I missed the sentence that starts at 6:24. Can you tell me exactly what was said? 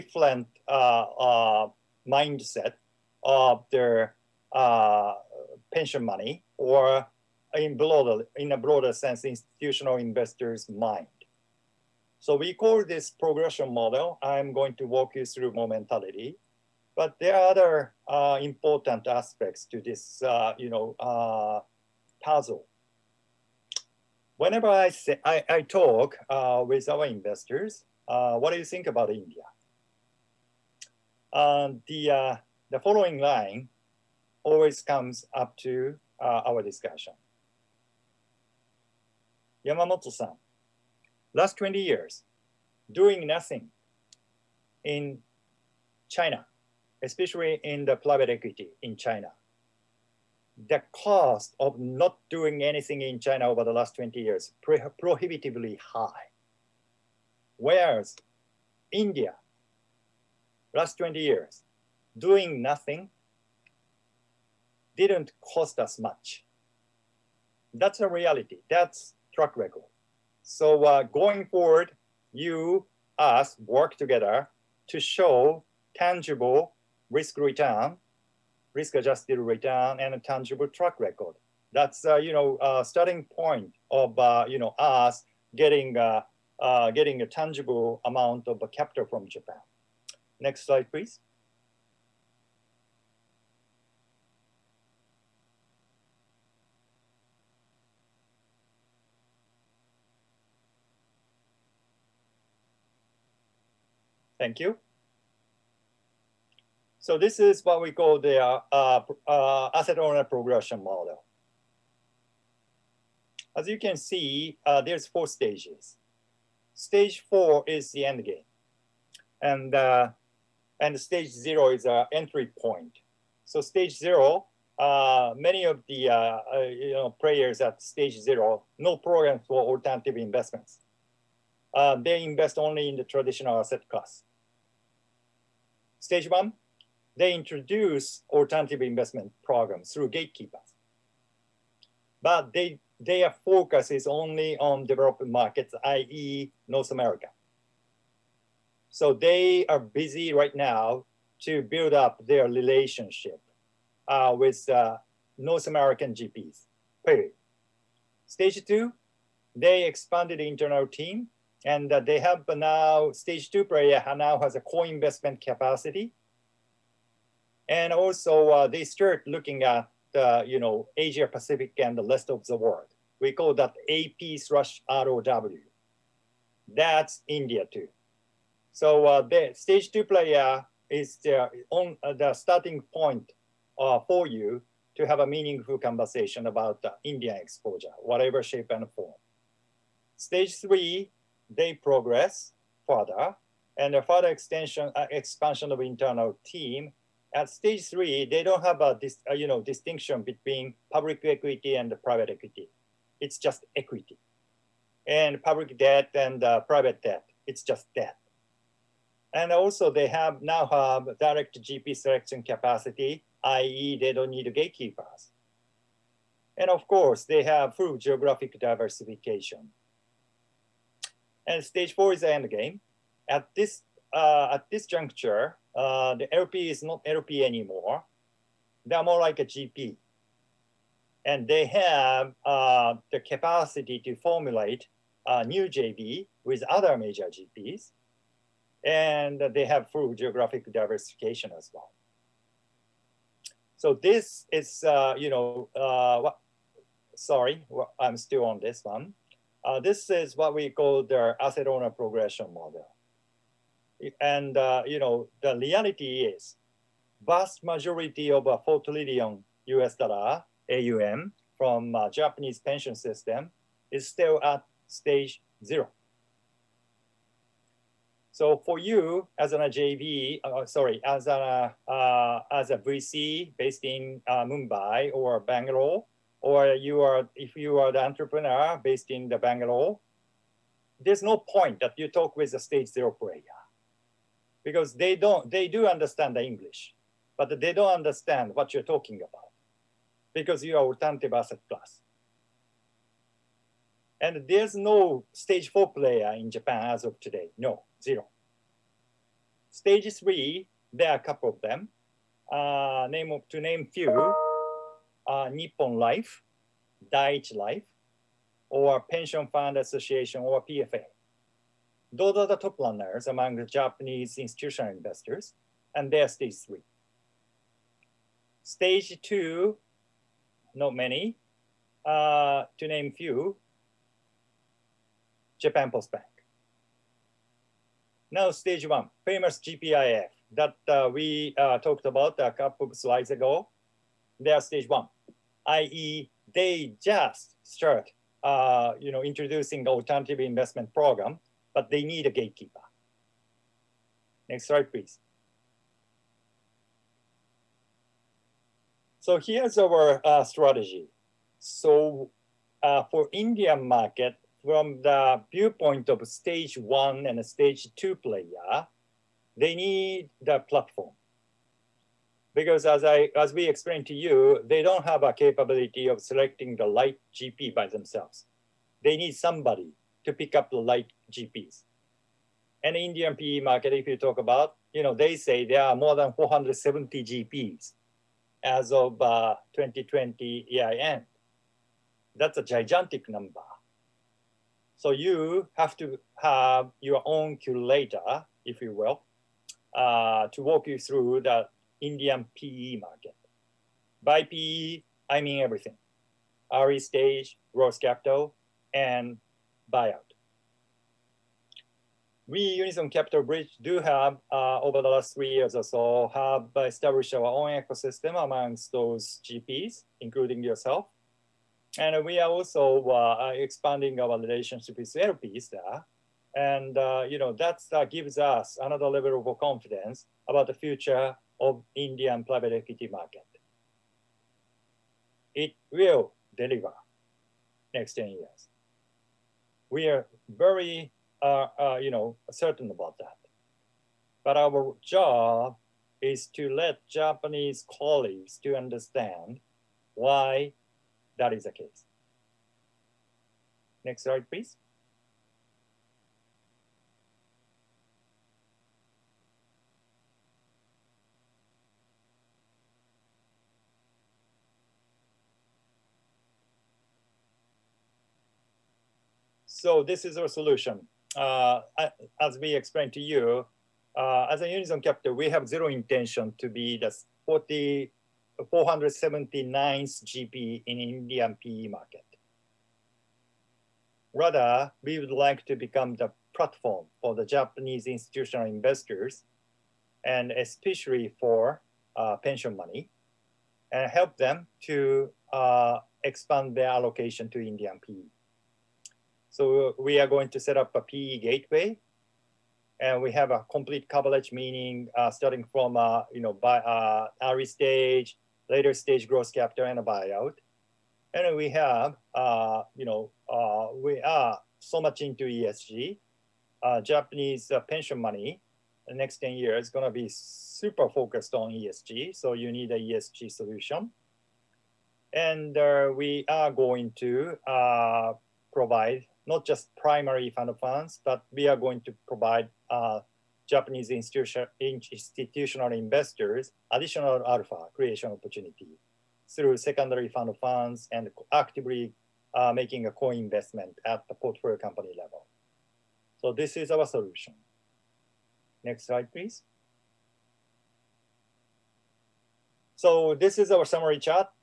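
So you have to have your own curator, if you will, uh, to walk you through the Indian PE market.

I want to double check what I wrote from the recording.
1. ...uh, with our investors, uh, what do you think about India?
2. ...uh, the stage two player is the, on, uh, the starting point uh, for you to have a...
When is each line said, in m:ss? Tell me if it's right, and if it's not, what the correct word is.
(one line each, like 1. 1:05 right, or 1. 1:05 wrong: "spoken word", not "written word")
1. 0:26 right
2. 2:59 right.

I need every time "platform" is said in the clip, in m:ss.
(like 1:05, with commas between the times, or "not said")
6:00, 7:56.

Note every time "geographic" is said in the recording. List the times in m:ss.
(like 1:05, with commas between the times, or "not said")
3:37, 4:00.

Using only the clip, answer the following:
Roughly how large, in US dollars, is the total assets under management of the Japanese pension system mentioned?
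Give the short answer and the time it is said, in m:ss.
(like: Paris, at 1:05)
$4 trillion, at 4:18.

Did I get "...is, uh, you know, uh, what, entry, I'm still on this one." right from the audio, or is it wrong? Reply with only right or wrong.
wrong.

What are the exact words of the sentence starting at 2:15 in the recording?
Stage one, they introduce alternative investment programs through gatekeepers.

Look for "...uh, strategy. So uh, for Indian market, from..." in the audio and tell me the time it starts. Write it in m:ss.
5:50.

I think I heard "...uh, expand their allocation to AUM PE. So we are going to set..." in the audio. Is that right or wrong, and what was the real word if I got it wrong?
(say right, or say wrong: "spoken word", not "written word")
wrong: "Indian", not "AUM".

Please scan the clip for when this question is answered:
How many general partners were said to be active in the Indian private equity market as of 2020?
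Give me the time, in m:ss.
6:16.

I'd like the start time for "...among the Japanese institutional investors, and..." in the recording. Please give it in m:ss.
5:13.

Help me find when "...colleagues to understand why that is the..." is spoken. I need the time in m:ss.
7:17.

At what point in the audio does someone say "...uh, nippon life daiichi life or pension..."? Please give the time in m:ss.
5:05.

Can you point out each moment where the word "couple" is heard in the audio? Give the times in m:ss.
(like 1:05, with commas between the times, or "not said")
5:01, 5:32.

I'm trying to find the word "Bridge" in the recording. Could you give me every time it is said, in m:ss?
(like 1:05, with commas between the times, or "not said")
6:43.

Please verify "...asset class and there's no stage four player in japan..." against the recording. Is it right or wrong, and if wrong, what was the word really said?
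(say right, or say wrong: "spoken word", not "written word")
right.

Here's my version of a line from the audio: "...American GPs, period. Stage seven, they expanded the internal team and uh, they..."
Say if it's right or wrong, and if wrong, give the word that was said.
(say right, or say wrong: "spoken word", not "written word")
wrong: "two", not "seven".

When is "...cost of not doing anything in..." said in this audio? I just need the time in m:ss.
0:50.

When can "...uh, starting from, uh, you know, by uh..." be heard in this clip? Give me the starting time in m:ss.
8:15.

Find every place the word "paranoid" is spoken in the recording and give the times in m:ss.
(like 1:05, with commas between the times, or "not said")
not said.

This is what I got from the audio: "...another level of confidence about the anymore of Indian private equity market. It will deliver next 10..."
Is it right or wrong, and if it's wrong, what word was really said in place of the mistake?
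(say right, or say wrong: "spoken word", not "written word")
wrong: "future", not "anymore".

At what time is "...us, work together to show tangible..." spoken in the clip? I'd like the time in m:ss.
1:13.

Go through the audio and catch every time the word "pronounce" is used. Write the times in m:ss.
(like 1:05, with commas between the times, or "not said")
not said.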